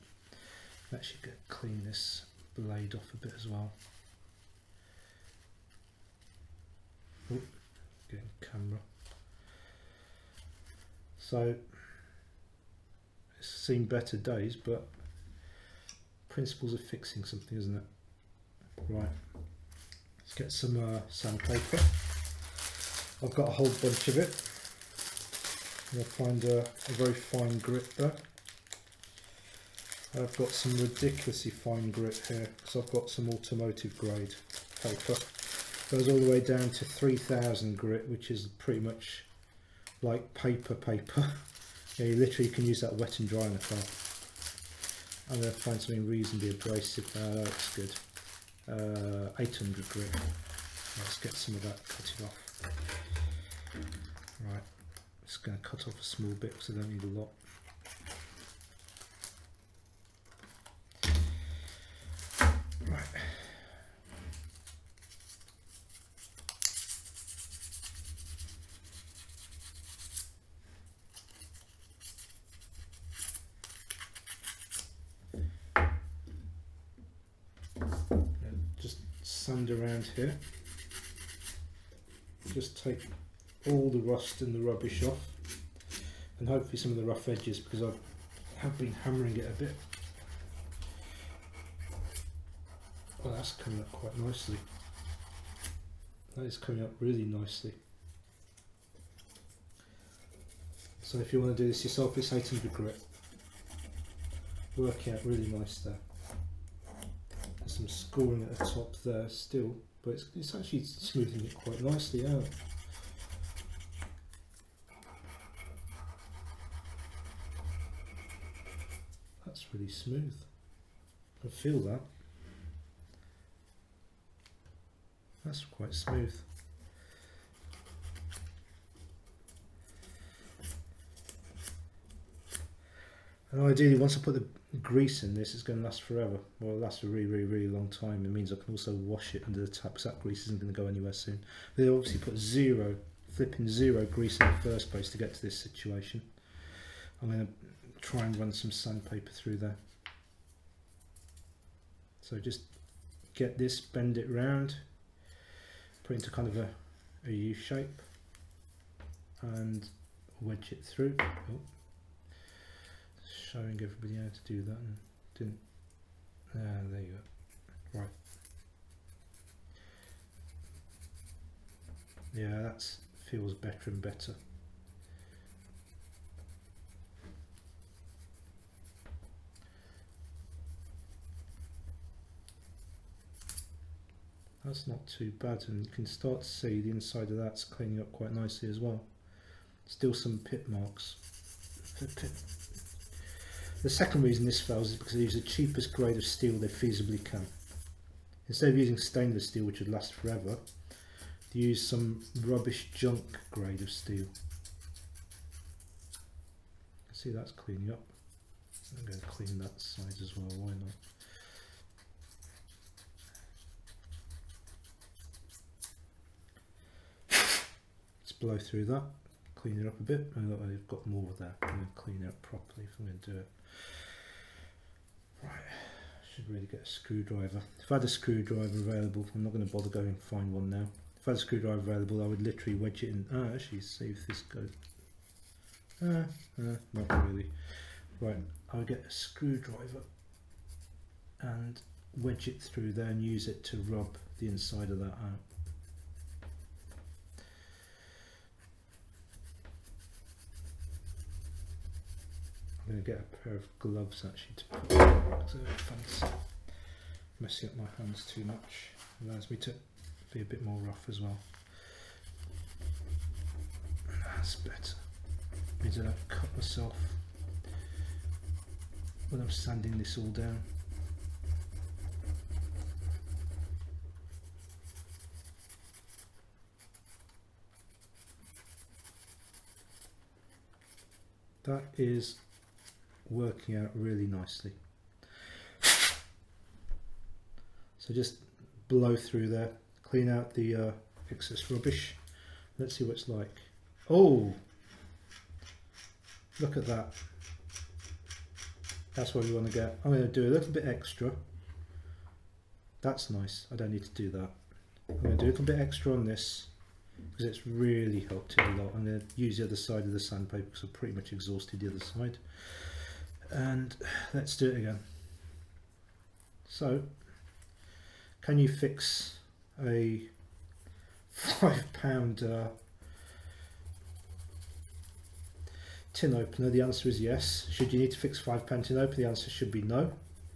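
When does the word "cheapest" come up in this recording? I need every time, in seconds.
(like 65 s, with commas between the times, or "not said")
195 s.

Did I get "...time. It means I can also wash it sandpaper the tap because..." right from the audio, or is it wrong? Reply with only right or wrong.
wrong.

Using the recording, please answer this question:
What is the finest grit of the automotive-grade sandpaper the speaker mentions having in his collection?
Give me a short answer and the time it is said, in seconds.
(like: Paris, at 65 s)
3000, at 36 s.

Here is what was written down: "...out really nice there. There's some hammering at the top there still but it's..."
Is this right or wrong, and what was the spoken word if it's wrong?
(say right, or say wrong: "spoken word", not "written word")
wrong: "scoring", not "hammering".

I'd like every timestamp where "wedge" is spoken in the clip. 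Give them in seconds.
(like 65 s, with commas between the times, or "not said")
160 s, 232 s, 242 s.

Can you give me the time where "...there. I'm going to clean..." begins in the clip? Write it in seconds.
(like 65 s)
221 s.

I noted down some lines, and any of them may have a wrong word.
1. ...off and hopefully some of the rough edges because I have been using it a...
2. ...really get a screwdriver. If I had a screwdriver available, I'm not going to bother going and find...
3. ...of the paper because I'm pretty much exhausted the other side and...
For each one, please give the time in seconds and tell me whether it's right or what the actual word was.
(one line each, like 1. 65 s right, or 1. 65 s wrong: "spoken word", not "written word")
1. 85 s wrong: "hammering", not "using"
2. 226 s right
3. 310 s wrong: "sandpaper", not "paper".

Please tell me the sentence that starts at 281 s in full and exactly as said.
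That is working out really nicely.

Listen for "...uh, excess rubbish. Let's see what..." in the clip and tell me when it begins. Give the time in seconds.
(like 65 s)
290 s.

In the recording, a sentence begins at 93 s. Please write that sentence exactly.
Well that's coming up quite nicely.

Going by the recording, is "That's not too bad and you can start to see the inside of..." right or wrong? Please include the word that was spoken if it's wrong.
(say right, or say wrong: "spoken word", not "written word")
right.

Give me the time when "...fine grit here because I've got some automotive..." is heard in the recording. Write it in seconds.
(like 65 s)
31 s.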